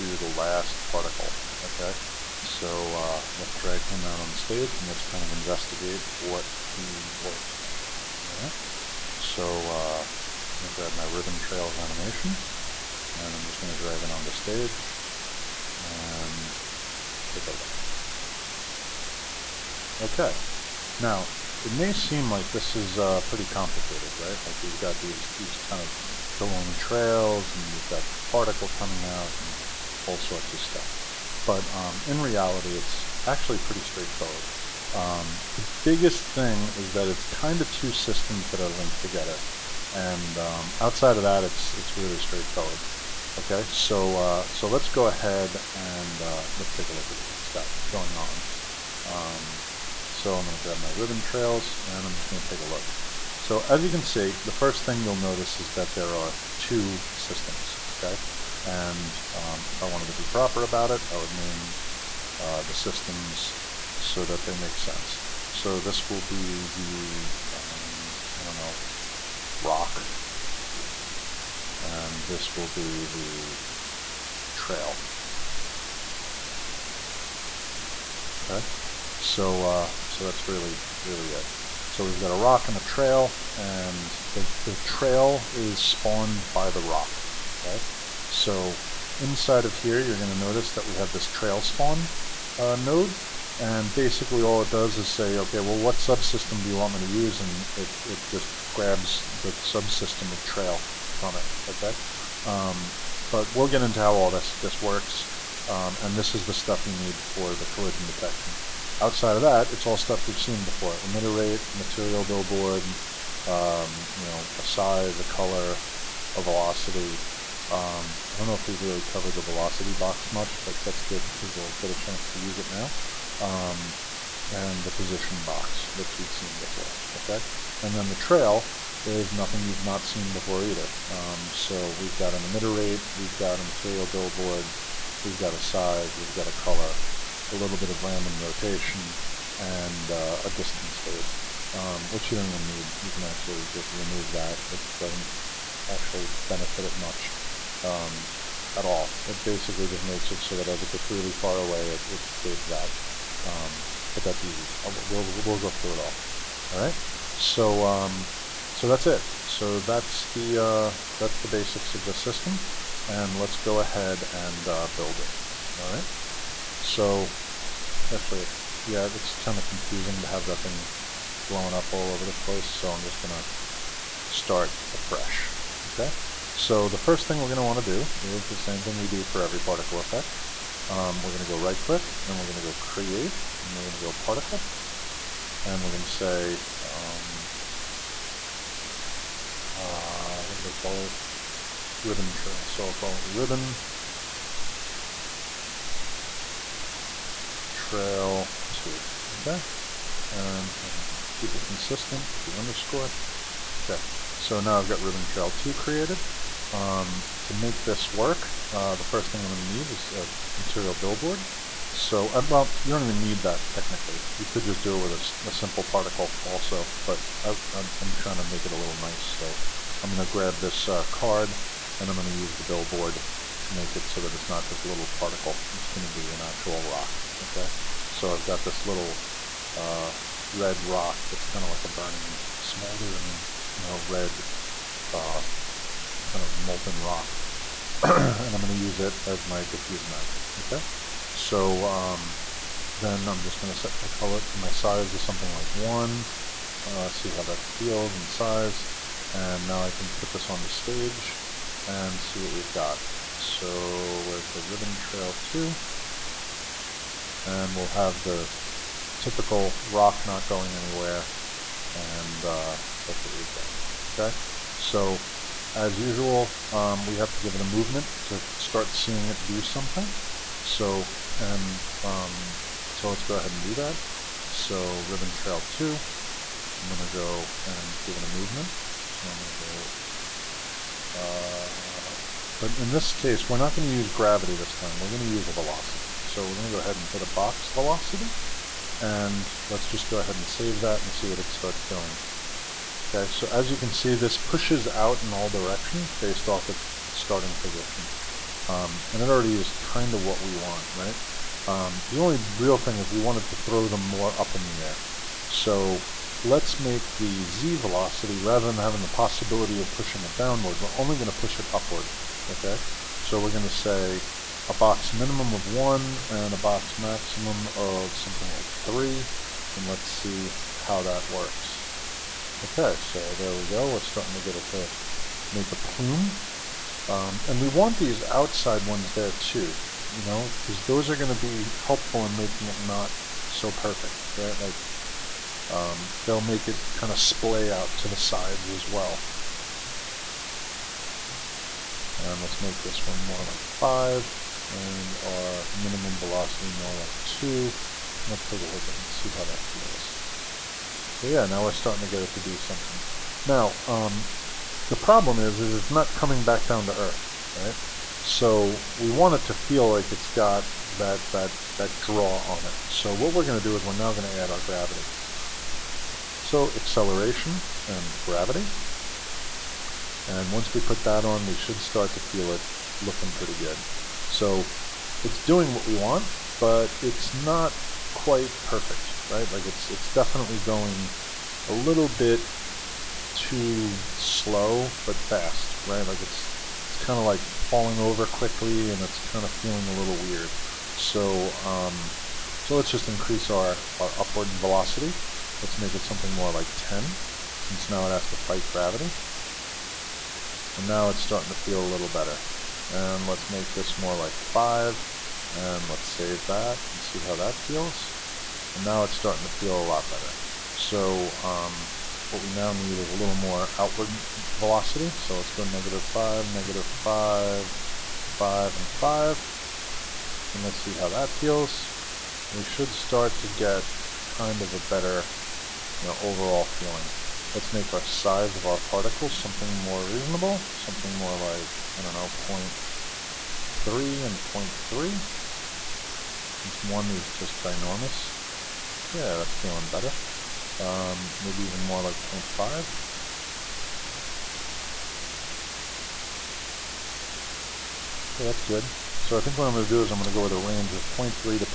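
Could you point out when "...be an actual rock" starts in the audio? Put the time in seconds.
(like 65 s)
226 s.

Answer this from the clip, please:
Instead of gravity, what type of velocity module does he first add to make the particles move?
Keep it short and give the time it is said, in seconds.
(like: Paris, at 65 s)
box velocity, at 287 s.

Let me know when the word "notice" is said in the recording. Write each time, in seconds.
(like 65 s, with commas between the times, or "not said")
55 s, 90 s.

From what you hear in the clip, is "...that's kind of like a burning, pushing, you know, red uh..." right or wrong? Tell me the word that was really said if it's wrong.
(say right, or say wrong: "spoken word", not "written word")
wrong: "smoldering", not "pushing".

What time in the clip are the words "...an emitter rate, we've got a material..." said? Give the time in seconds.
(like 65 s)
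132 s.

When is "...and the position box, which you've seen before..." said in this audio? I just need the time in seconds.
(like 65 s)
124 s.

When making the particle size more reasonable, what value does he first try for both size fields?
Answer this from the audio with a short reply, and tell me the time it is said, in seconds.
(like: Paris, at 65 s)
0.3, at 432 s.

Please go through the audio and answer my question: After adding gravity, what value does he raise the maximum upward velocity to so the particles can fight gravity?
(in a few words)
10.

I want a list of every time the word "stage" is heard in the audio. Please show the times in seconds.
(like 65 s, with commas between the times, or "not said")
4 s, 14 s, 250 s.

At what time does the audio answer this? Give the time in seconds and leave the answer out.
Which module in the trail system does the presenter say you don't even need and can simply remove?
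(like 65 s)
140 s.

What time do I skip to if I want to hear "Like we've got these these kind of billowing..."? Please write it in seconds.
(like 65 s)
24 s.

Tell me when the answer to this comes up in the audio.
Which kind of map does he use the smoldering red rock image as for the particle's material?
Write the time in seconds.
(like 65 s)
239 s.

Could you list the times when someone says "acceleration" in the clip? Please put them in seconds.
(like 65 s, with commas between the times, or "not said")
366 s.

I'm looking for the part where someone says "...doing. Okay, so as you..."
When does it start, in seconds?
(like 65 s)
291 s.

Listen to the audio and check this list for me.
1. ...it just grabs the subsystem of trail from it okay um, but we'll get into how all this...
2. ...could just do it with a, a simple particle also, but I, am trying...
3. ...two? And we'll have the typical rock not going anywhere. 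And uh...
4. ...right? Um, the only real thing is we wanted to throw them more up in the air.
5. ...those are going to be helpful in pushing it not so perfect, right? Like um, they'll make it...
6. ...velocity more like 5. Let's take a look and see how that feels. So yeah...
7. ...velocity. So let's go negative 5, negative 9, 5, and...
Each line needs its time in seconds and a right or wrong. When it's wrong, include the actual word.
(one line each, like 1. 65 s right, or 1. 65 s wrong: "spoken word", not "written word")
1. 98 s right
2. 214 s right
3. 255 s right
4. 300 s right
5. 330 s wrong: "making", not "pushing"
6. 346 s wrong: "2", not "5"
7. 414 s wrong: "5", not "9".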